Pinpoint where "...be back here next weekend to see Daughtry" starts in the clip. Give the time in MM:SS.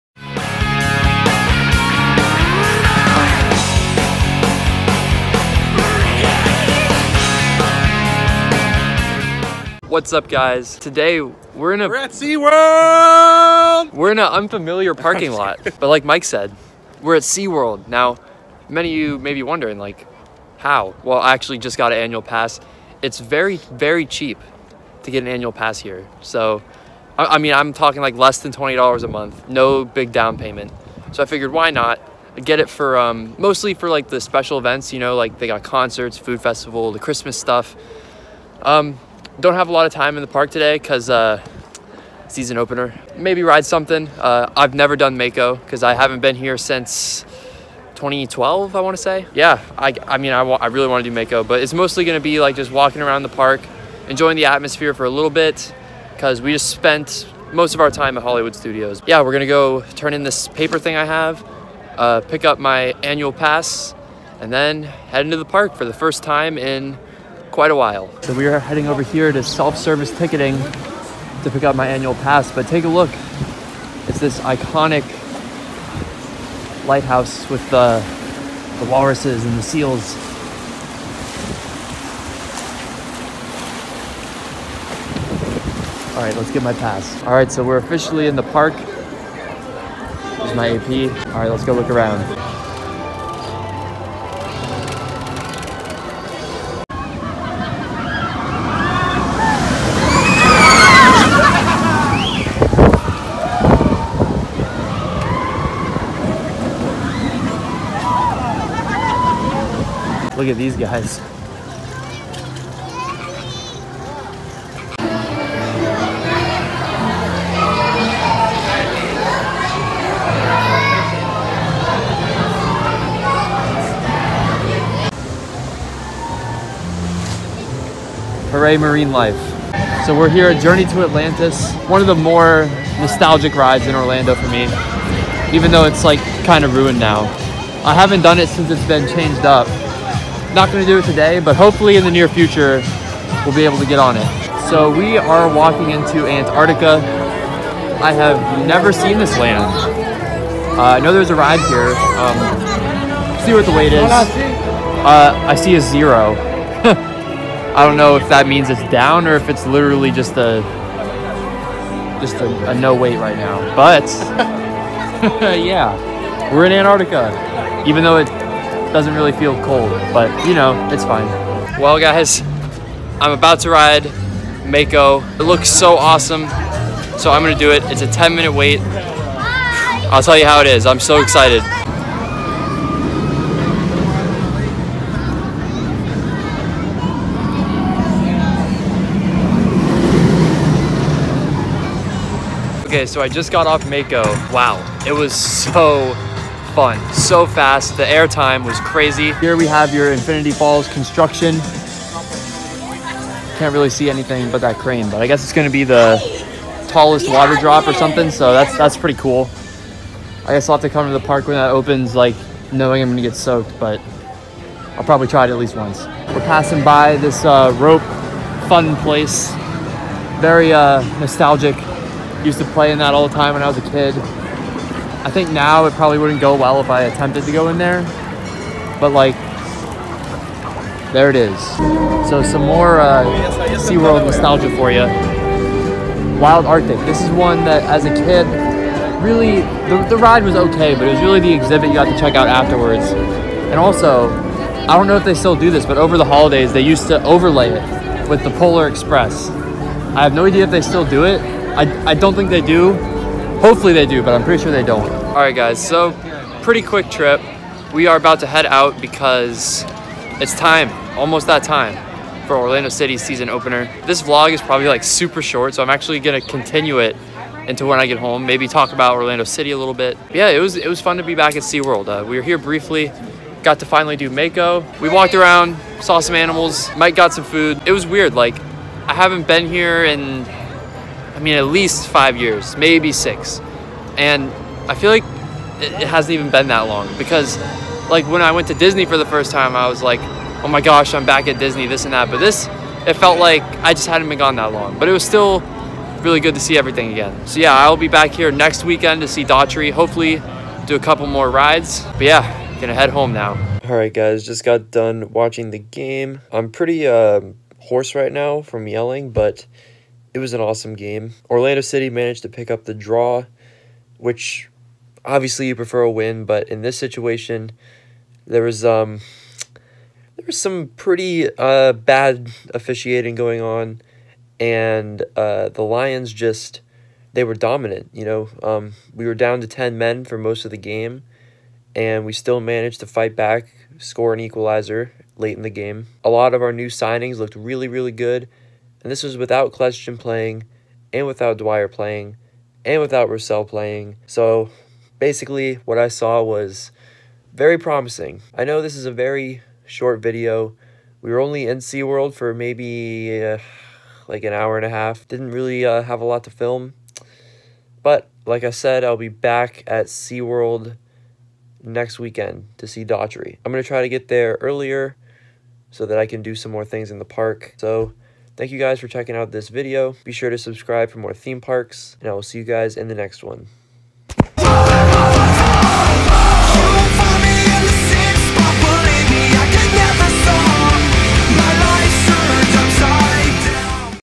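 04:57.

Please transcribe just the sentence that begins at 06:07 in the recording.
So Thank you guys for checking out this video.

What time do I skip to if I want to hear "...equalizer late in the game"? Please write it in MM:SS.
05:34.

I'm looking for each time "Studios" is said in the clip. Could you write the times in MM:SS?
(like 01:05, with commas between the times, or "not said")
00:58.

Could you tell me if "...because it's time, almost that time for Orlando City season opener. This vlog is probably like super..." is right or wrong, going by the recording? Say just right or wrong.
right.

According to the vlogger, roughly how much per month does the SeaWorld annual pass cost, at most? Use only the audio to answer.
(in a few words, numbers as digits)
less than $20.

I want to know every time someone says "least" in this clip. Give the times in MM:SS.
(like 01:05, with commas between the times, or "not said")
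03:35, 04:41.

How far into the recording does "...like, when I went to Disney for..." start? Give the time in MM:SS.
04:48.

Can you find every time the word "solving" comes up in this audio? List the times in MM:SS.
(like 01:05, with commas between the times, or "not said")
not said.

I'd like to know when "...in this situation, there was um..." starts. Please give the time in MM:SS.
05:16.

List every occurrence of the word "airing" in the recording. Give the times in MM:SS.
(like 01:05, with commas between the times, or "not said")
not said.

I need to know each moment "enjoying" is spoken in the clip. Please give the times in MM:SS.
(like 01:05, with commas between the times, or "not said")
00:54.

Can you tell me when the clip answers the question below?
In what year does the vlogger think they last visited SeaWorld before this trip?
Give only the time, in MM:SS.
00:47.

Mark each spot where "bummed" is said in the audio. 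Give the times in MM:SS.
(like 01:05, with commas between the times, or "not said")
not said.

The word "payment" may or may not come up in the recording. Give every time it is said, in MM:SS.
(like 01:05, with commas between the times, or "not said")
00:30.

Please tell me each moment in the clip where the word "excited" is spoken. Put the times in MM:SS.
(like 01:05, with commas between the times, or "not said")
03:01.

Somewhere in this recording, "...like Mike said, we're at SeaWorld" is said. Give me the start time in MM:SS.
00:15.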